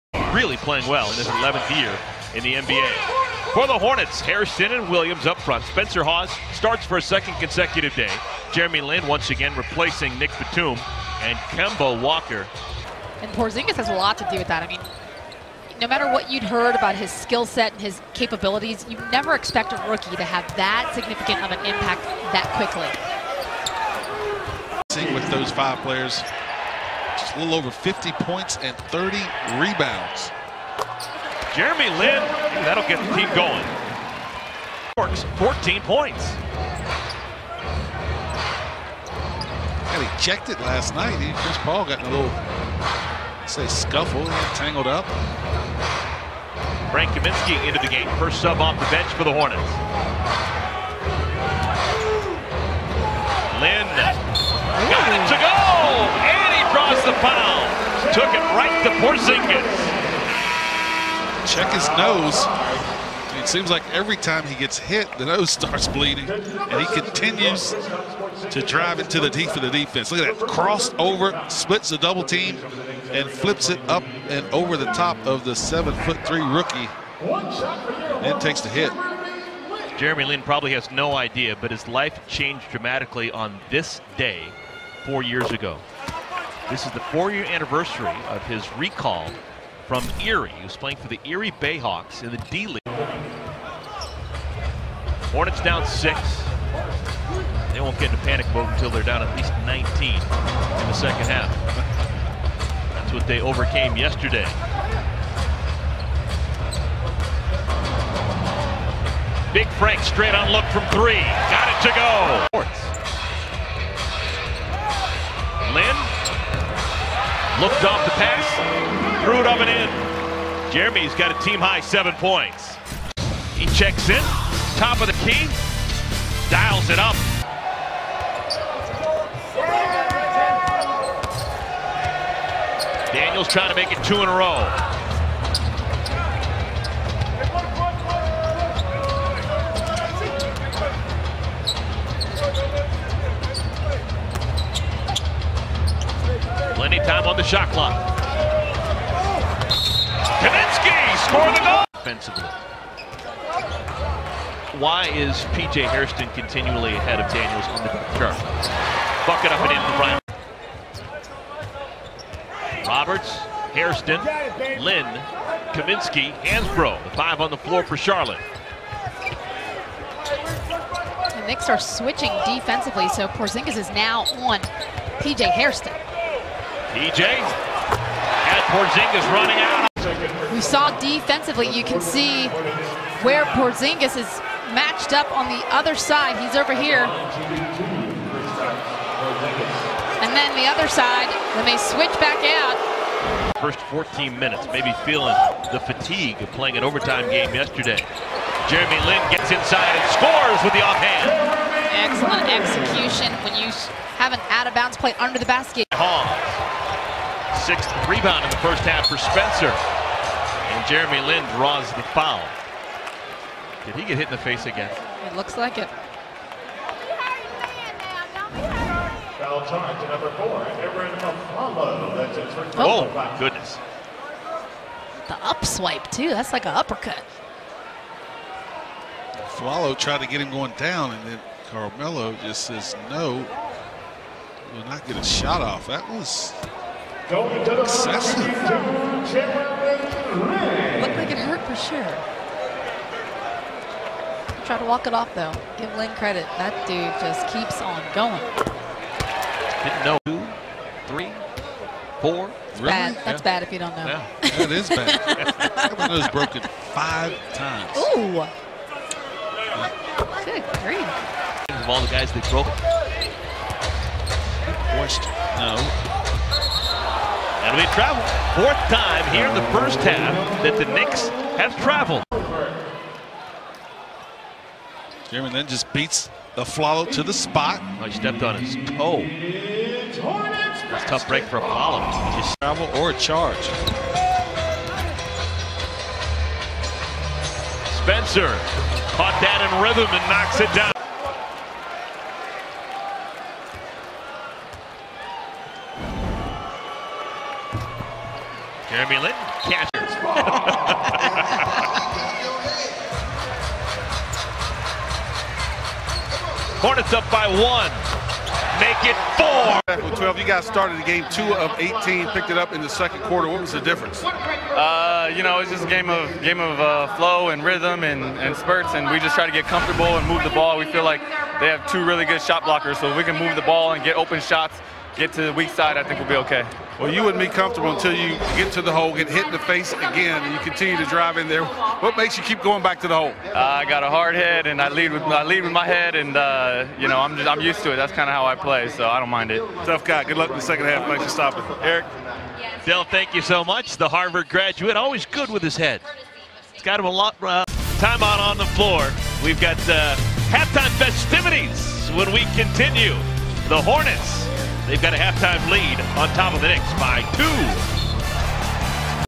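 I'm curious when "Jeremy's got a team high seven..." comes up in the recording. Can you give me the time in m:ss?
2:00.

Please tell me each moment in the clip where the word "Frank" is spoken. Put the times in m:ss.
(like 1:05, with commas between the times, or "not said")
0:46, 1:49.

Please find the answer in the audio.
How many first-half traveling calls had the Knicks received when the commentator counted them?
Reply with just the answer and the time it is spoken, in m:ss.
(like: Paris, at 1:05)
4, at 4:28.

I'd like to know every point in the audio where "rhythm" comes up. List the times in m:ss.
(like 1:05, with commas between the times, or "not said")
4:49, 5:17.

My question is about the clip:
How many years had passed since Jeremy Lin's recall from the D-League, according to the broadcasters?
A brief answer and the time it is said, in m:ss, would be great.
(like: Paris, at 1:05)
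4, at 1:27.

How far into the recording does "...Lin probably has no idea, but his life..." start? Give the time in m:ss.
1:20.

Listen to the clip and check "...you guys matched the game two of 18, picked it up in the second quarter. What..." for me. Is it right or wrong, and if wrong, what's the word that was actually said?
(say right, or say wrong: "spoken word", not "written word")
wrong: "started", not "matched".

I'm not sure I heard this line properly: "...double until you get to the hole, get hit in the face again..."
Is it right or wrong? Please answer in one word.
wrong.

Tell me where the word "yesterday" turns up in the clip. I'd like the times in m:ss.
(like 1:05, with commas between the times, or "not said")
1:43, 3:17.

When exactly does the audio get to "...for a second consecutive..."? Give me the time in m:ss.
0:06.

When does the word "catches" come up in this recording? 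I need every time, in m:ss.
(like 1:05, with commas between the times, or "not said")
4:59.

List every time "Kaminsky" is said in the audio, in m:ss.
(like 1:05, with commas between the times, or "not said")
0:47, 2:30, 2:45.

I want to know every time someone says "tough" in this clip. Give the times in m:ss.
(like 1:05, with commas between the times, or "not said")
4:41, 5:39.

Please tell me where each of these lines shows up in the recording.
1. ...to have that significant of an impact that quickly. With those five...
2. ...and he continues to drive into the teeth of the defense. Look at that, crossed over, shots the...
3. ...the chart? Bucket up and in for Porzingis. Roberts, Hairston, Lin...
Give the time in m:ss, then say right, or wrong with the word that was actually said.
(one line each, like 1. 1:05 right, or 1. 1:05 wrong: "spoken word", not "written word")
1. 0:20 right
2. 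1:06 wrong: "splits", not "shots"
3. 2:37 wrong: "Brian", not "Porzingis".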